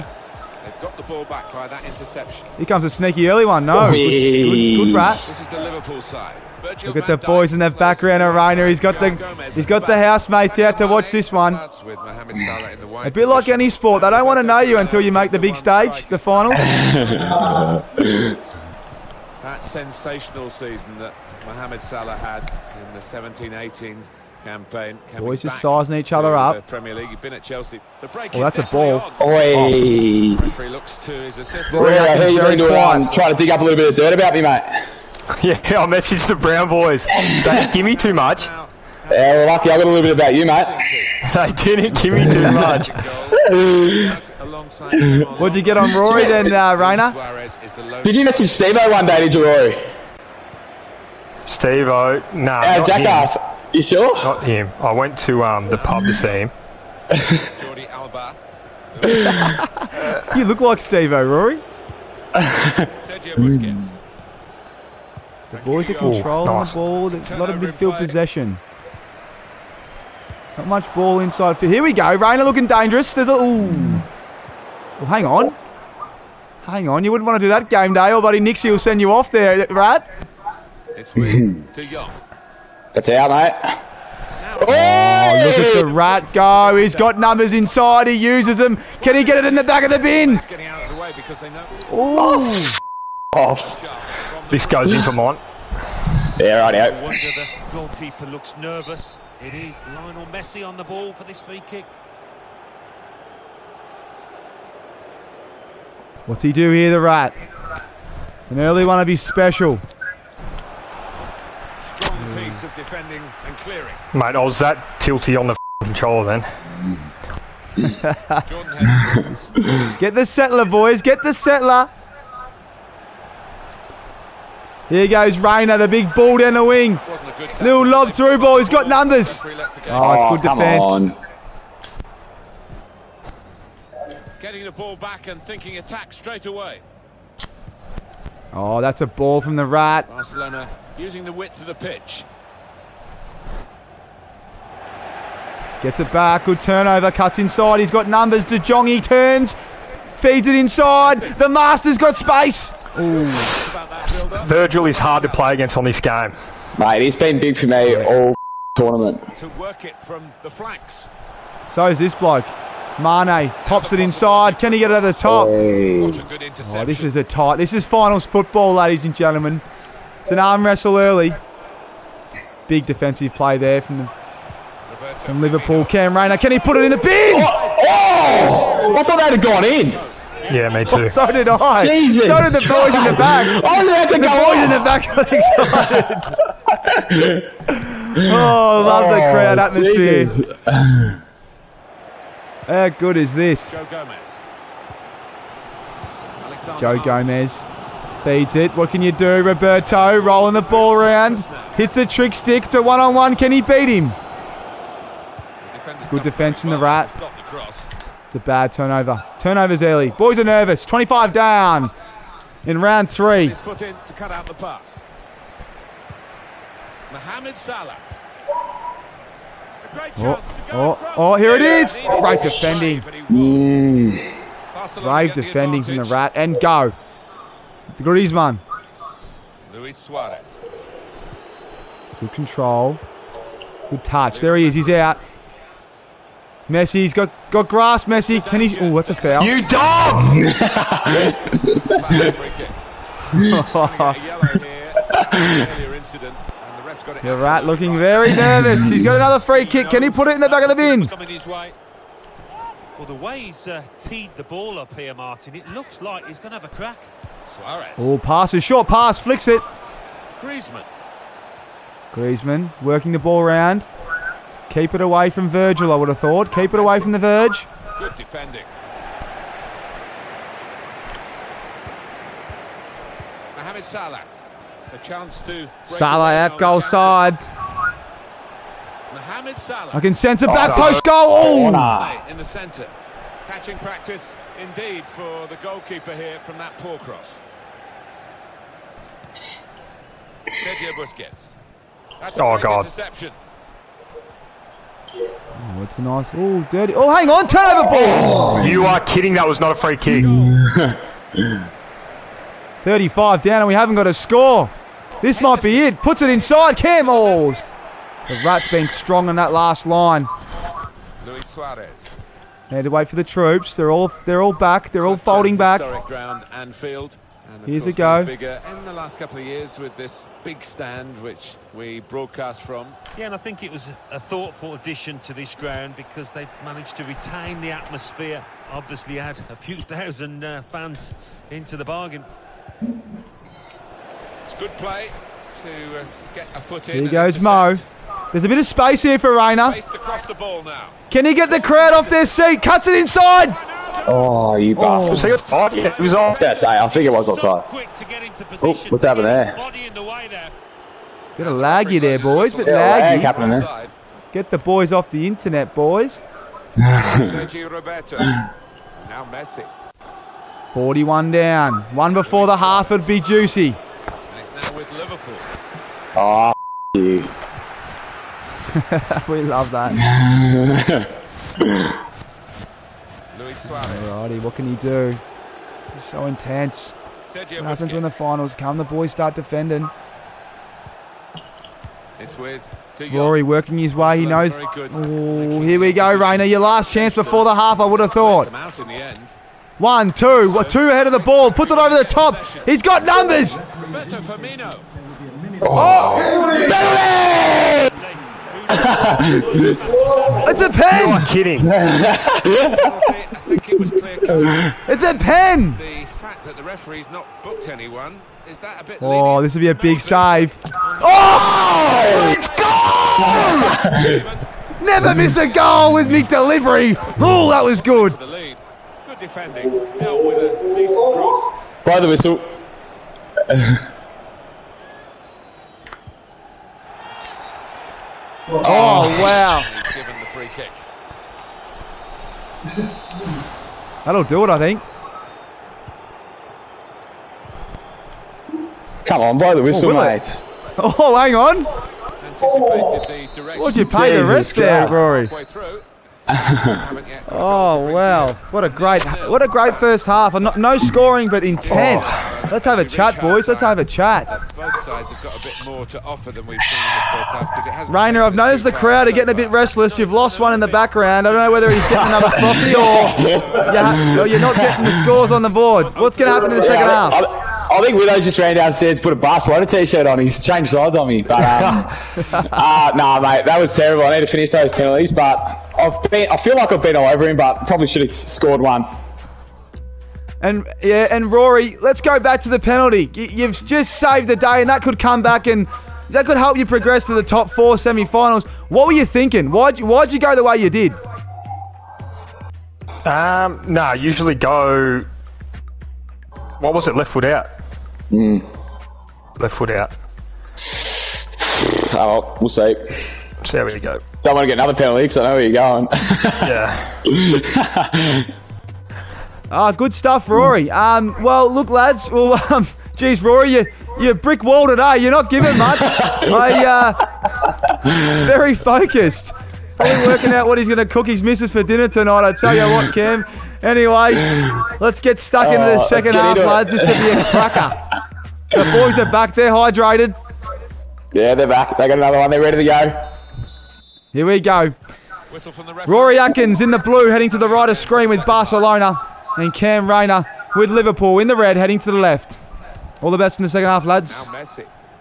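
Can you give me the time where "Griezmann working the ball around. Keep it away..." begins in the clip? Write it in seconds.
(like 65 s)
262 s.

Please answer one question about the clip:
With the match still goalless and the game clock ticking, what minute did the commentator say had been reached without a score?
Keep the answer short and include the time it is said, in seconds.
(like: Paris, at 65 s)
35, at 302 s.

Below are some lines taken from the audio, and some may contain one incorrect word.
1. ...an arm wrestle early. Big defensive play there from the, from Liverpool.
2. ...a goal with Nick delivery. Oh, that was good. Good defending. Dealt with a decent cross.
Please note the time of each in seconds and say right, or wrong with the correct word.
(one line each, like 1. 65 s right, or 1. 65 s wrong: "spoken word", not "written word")
1. 170 s right
2. 415 s right.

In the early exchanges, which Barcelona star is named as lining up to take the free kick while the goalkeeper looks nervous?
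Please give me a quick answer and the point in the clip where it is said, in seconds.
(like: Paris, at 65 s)
Lionel Messi, at 99 s.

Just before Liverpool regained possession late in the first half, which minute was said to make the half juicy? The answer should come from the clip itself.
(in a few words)
41.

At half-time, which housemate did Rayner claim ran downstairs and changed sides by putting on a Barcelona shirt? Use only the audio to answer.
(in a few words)
Willows.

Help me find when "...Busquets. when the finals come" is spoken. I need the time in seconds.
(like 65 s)
377 s.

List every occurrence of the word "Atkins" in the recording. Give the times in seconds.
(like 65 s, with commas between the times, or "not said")
536 s.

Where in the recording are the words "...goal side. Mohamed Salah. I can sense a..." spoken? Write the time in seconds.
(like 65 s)
276 s.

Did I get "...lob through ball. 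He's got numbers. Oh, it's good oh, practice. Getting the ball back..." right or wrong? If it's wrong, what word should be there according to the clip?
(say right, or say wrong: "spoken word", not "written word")
wrong: "defence", not "practice".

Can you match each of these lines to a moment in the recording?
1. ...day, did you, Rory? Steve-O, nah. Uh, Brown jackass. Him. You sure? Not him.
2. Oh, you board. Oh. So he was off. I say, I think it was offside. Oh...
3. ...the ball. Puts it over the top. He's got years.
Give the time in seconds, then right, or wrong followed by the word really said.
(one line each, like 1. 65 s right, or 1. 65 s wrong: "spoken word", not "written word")
1. 49 s wrong: "Our", not "Brown"
2. 344 s wrong: "bastard", not "board"
3. 391 s wrong: "numbers", not "years".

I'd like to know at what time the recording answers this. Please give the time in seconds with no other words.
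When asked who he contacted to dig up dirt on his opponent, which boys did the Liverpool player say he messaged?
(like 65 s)
36 s.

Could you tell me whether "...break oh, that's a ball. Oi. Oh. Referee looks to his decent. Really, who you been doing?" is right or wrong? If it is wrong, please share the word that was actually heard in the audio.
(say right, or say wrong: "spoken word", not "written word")
wrong: "assistant", not "decent".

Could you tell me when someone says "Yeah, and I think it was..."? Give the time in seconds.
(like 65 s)
323 s.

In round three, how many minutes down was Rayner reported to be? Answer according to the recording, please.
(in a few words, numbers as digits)
25.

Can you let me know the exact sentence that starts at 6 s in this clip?
Virgil Look at the boys in the background of Rayner.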